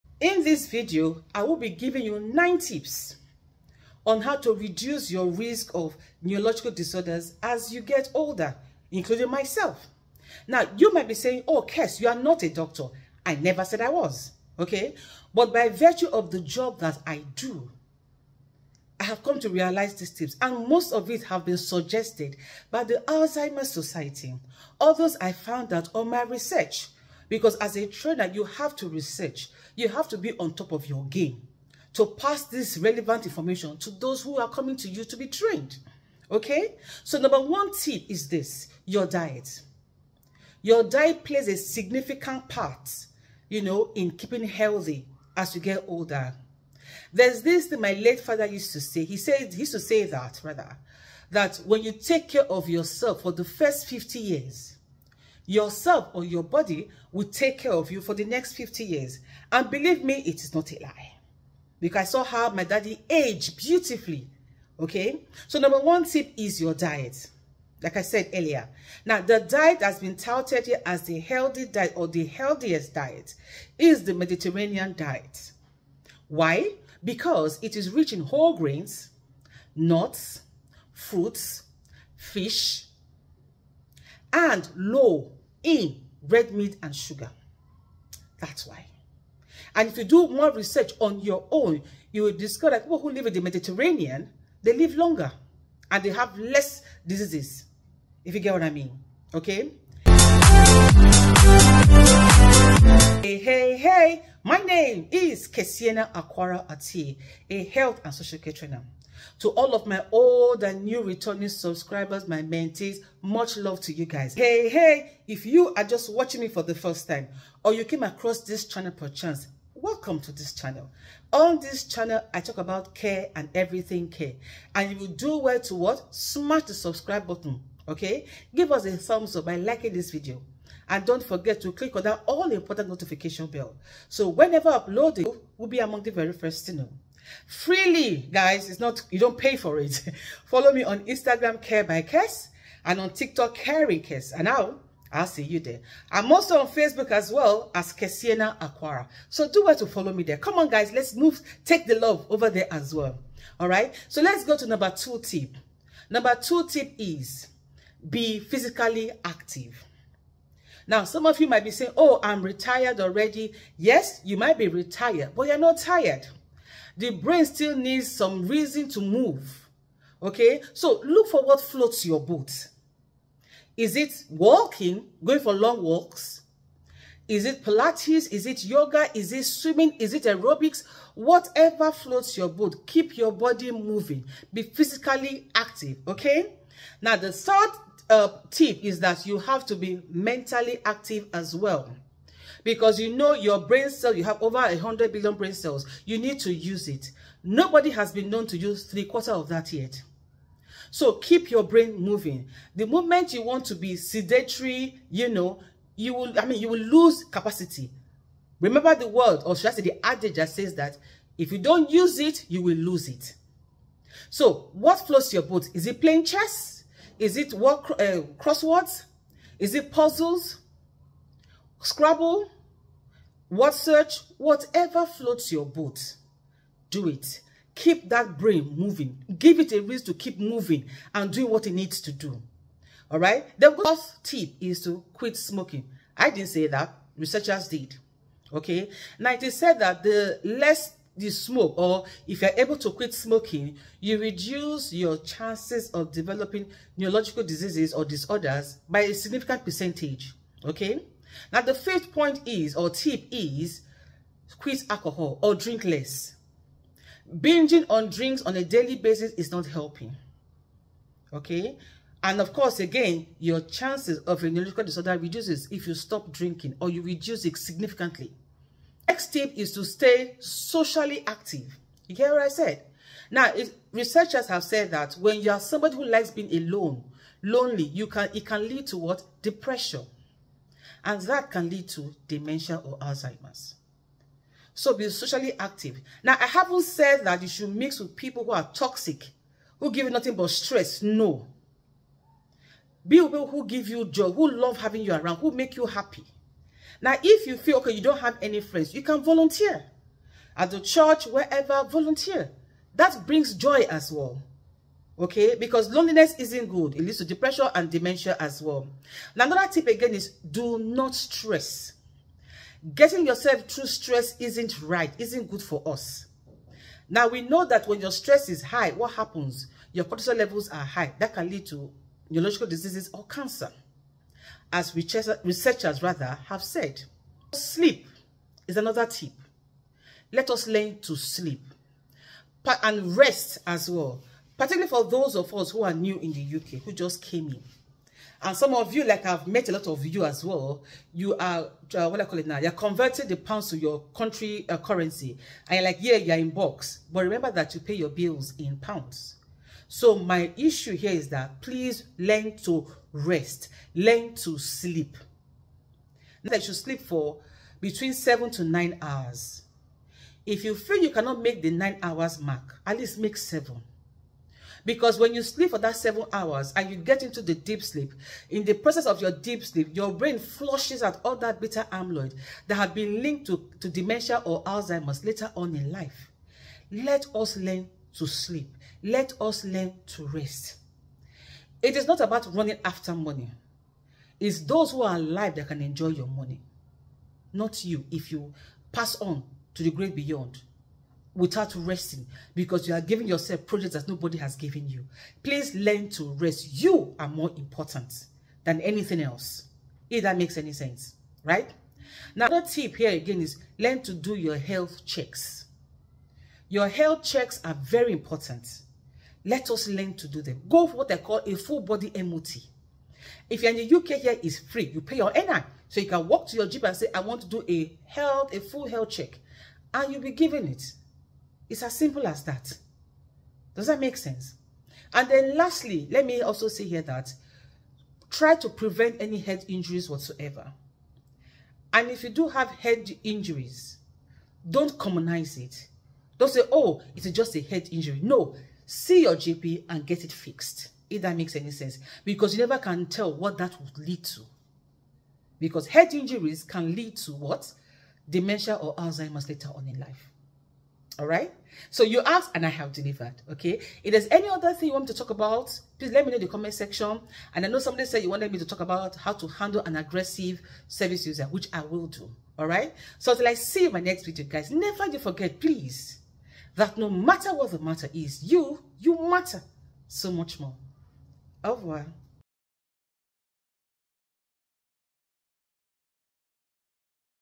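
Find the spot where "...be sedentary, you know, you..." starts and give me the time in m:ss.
3:23.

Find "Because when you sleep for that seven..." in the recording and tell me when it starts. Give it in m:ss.
6:04.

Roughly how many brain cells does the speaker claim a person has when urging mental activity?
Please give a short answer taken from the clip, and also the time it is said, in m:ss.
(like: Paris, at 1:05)
Over 100 billion, at 3:14.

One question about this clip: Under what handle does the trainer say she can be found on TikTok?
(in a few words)
caring Kess.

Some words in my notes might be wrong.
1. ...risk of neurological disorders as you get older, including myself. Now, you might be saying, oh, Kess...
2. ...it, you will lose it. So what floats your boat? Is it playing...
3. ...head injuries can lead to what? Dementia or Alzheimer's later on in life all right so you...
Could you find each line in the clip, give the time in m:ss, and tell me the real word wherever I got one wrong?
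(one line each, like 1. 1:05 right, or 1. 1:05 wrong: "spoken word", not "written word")
1. 0:05 right
2. 3:32 right
3. 7:25 right.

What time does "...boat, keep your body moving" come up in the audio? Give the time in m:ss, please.
3:02.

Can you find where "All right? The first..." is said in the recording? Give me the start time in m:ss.
3:53.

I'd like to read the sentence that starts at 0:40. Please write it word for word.
Your diet plays a significant part, you know, in keeping healthy as you get older.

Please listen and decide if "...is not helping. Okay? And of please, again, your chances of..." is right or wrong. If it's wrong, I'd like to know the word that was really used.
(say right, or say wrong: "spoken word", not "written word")
wrong: "course", not "please".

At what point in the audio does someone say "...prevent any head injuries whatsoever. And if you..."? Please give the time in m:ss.
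7:08.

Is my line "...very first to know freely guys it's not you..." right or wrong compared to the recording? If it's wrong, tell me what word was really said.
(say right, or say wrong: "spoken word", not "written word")
right.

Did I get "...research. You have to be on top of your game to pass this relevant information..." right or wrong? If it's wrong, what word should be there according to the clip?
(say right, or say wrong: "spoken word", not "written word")
right.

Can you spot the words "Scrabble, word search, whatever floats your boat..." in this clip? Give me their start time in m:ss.
3:41.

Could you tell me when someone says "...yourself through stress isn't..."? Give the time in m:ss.
5:13.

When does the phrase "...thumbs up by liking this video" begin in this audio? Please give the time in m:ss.
2:08.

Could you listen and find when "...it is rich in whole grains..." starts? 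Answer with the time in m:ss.
1:17.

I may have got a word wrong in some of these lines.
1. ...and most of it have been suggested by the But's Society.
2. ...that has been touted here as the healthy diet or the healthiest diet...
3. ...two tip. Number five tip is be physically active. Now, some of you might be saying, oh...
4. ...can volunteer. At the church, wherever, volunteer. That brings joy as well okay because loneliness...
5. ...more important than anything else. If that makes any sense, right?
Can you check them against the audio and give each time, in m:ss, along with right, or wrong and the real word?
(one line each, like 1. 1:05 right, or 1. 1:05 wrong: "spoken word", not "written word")
1. 0:20 wrong: "Alzheimer", not "But"
2. 1:09 right
3. 2:34 wrong: "two", not "five"
4. 4:59 right
5. 6:37 right.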